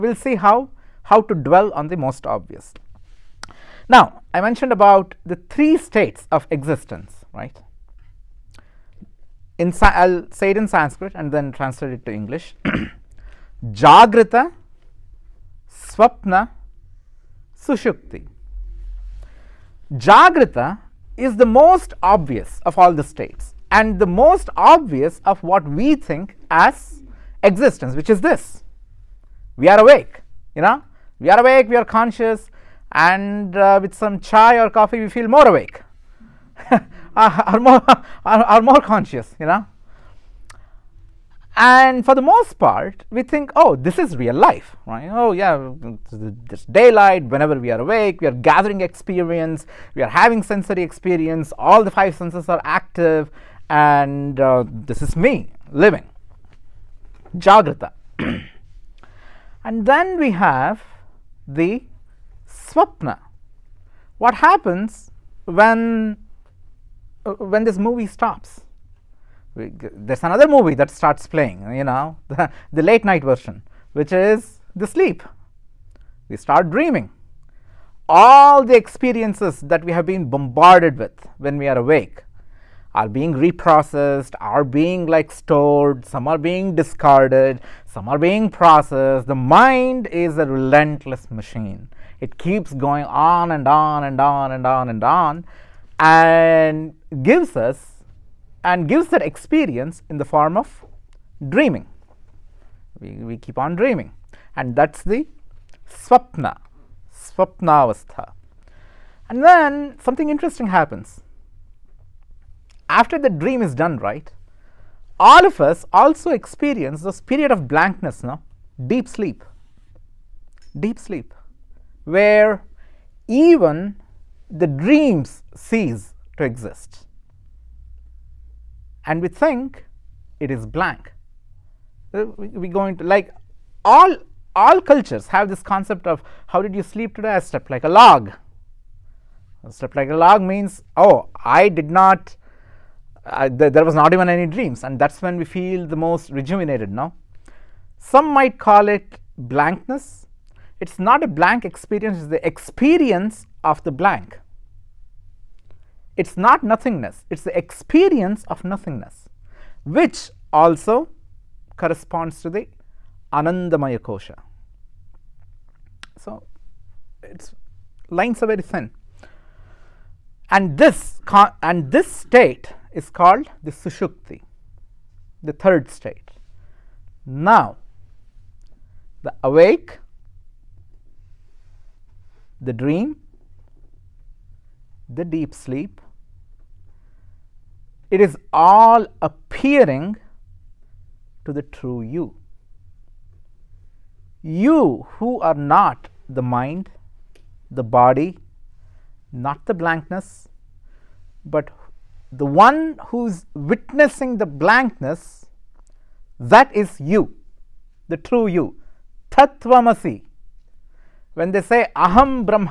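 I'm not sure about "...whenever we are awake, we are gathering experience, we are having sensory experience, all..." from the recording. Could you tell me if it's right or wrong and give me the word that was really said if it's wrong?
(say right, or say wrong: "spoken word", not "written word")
right.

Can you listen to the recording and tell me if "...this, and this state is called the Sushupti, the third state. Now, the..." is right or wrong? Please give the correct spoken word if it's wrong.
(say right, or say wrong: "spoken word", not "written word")
right.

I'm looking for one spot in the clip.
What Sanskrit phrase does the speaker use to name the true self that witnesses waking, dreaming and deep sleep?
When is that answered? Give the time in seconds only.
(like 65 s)
209 s.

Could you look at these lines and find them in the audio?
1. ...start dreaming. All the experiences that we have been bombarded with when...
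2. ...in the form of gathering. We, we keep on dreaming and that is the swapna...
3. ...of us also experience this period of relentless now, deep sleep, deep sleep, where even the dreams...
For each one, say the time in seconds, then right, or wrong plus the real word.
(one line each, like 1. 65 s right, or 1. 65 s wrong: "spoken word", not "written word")
1. 76 s right
2. 100 s wrong: "dreaming", not "gathering"
3. 115 s wrong: "blankness", not "relentless".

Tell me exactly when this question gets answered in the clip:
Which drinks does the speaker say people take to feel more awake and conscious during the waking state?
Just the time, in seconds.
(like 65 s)
34 s.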